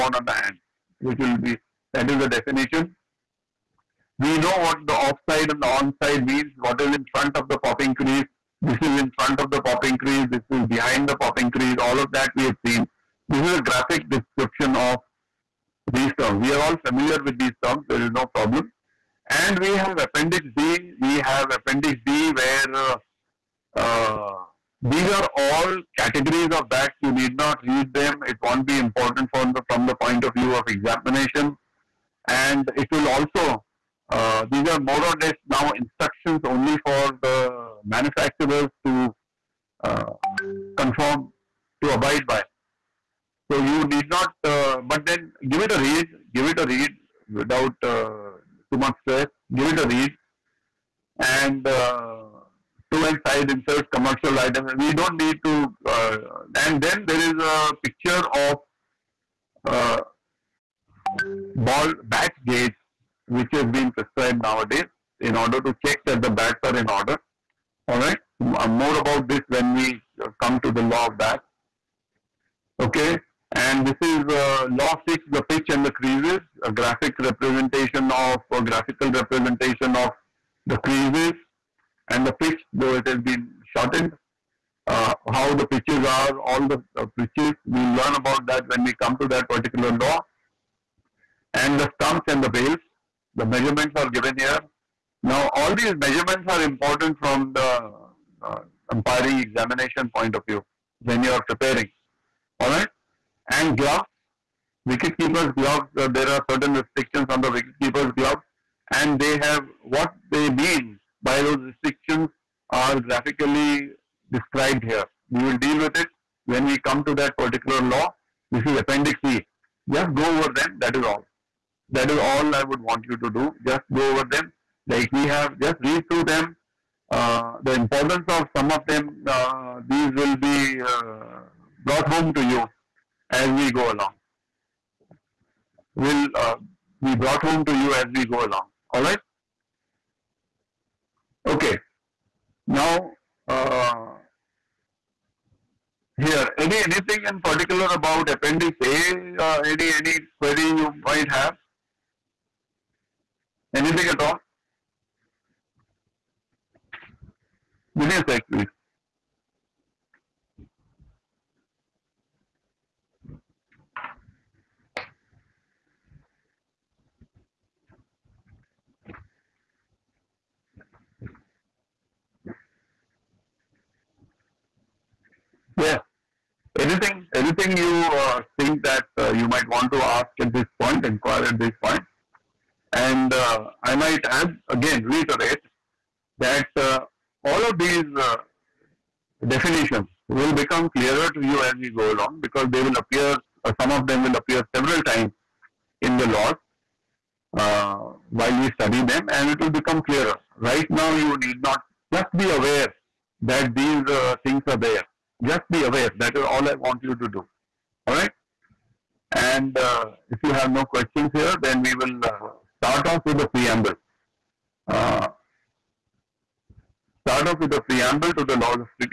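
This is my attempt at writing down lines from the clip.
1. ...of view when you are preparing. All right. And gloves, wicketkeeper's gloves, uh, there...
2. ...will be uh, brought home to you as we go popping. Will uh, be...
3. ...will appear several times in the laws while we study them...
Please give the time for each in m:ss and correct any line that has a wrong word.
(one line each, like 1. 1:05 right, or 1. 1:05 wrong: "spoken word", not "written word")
1. 1:40 right
2. 2:10 wrong: "along", not "popping"
3. 3:14 right.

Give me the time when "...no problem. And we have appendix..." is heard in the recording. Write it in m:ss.
0:18.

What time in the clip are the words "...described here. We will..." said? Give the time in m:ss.
1:54.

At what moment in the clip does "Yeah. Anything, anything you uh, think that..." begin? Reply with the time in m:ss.
2:55.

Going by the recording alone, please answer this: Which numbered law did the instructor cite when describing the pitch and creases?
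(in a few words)
Law 6.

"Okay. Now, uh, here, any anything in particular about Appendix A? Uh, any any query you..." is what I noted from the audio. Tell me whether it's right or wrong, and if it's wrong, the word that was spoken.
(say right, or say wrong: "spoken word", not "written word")
right.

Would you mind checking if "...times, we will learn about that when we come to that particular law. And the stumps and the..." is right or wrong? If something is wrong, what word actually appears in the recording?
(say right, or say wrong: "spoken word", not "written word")
wrong: "pitches", not "times".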